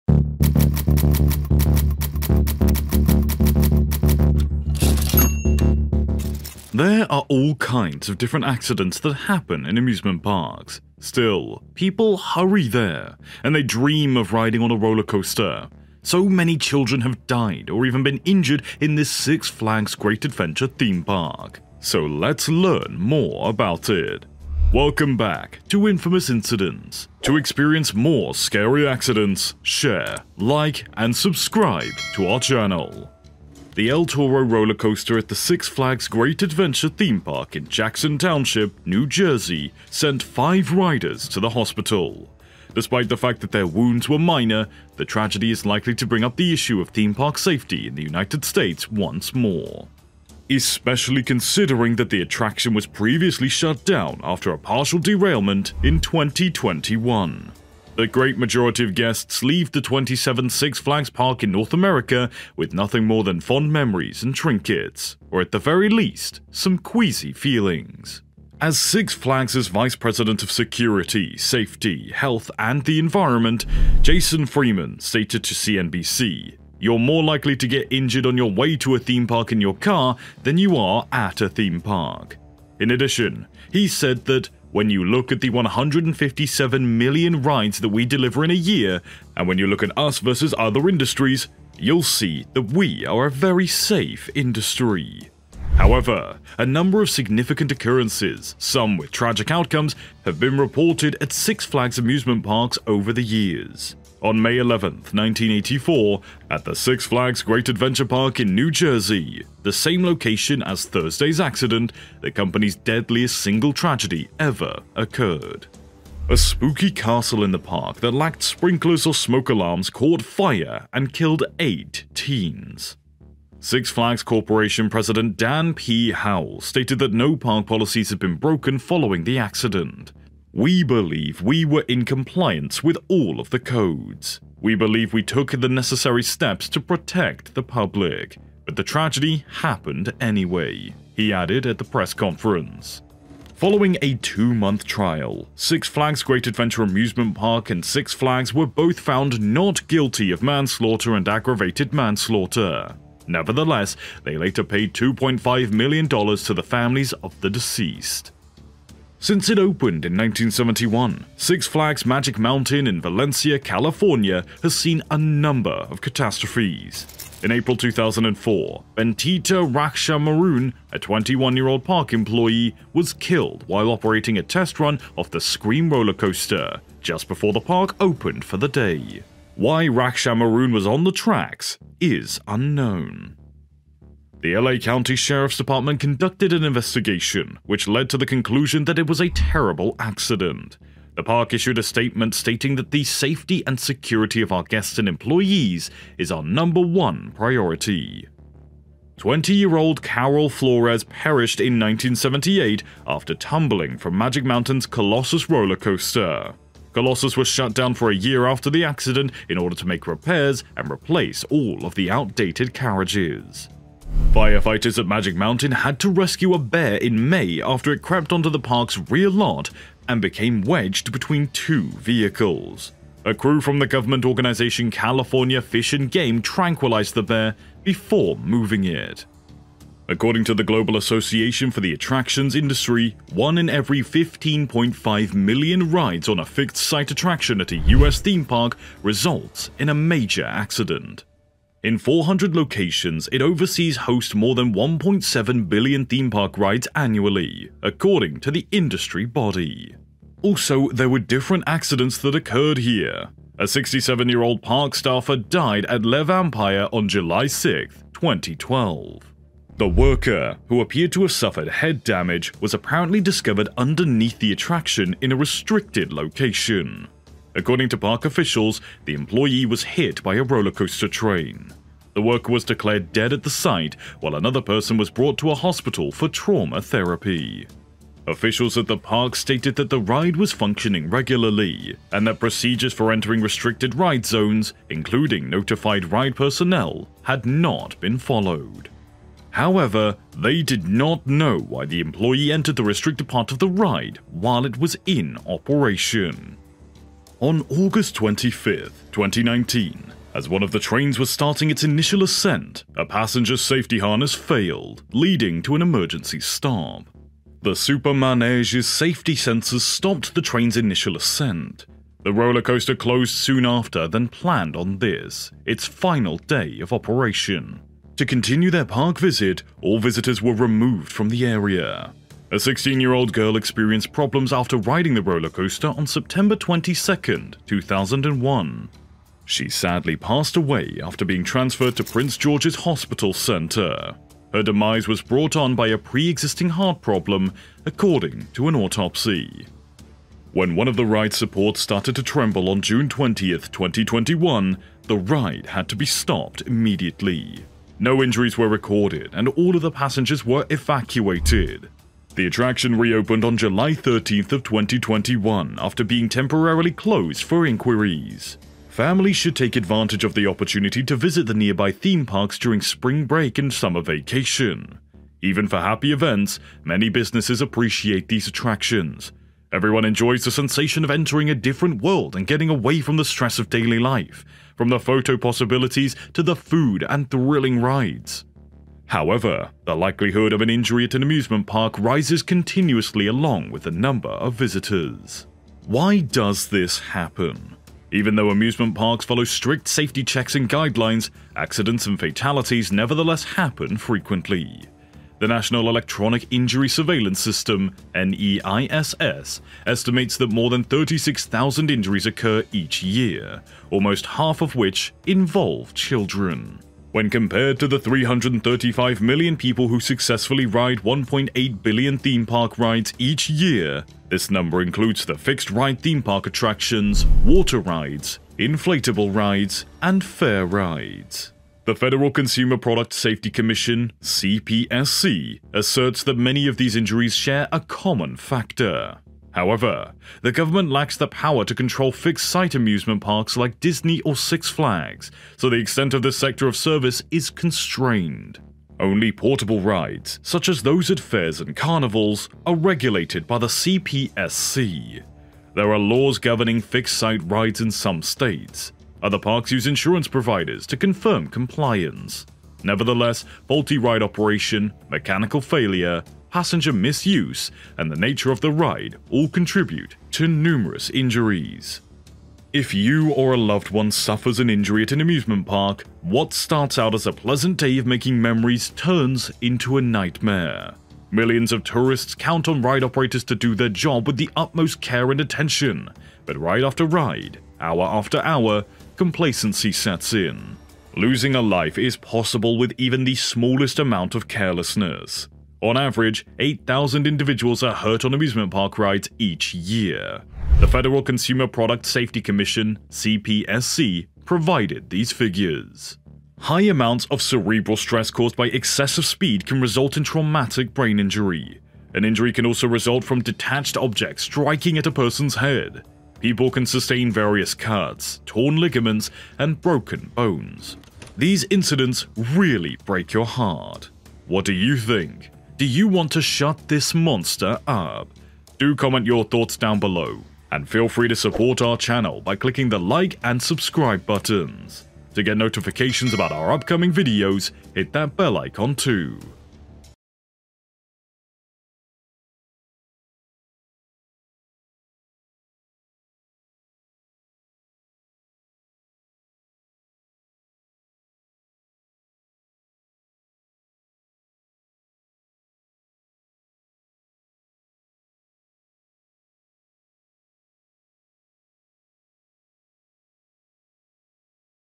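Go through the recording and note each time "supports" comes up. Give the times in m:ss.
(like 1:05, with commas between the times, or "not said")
5:41, 8:41.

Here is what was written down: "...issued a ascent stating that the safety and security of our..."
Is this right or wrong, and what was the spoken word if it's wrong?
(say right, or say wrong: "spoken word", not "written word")
wrong: "statement", not "ascent".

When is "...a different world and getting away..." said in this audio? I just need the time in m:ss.
6:11.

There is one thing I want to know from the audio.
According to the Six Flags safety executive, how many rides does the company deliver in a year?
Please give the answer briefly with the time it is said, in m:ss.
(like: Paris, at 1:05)
157 million, at 1:25.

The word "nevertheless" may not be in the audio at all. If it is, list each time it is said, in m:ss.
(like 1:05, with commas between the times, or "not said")
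2:33, 6:32, 7:32.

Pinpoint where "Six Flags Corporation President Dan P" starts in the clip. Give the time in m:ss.
2:03.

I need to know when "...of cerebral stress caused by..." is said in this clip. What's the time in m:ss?
8:17.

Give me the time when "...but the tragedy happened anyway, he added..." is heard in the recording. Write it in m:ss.
2:18.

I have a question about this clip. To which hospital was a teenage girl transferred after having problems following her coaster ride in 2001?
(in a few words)
Prince George's Hospital Centre.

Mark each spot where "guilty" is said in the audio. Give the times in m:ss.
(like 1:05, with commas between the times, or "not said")
2:29.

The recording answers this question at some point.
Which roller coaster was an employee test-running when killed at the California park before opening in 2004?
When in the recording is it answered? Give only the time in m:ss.
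2:55.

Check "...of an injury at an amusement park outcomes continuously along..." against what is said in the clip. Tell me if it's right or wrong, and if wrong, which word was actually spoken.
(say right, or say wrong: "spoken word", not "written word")
wrong: "rises", not "outcomes".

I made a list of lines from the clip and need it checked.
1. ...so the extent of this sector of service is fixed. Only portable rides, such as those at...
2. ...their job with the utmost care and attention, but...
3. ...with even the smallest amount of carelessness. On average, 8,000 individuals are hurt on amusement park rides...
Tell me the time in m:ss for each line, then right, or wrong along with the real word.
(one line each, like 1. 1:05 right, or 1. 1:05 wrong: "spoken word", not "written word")
1. 7:15 wrong: "constrained", not "fixed"
2. 7:53 right
3. 8:02 right.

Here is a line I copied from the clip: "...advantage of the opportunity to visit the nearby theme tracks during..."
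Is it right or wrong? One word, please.
wrong.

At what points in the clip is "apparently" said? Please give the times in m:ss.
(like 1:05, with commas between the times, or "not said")
4:22.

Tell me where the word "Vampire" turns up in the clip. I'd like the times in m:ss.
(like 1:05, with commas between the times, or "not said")
4:16.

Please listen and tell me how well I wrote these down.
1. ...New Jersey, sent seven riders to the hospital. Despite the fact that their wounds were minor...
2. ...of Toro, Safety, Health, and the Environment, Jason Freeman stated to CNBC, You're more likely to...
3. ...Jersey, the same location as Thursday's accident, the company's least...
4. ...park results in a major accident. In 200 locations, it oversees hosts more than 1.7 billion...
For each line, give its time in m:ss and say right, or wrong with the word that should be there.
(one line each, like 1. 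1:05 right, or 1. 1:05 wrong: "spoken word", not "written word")
1. 0:38 wrong: "five", not "seven"
2. 1:10 wrong: "Security", not "Toro"
3. 1:48 wrong: "deadliest", not "least"
4. 3:58 wrong: "400", not "200".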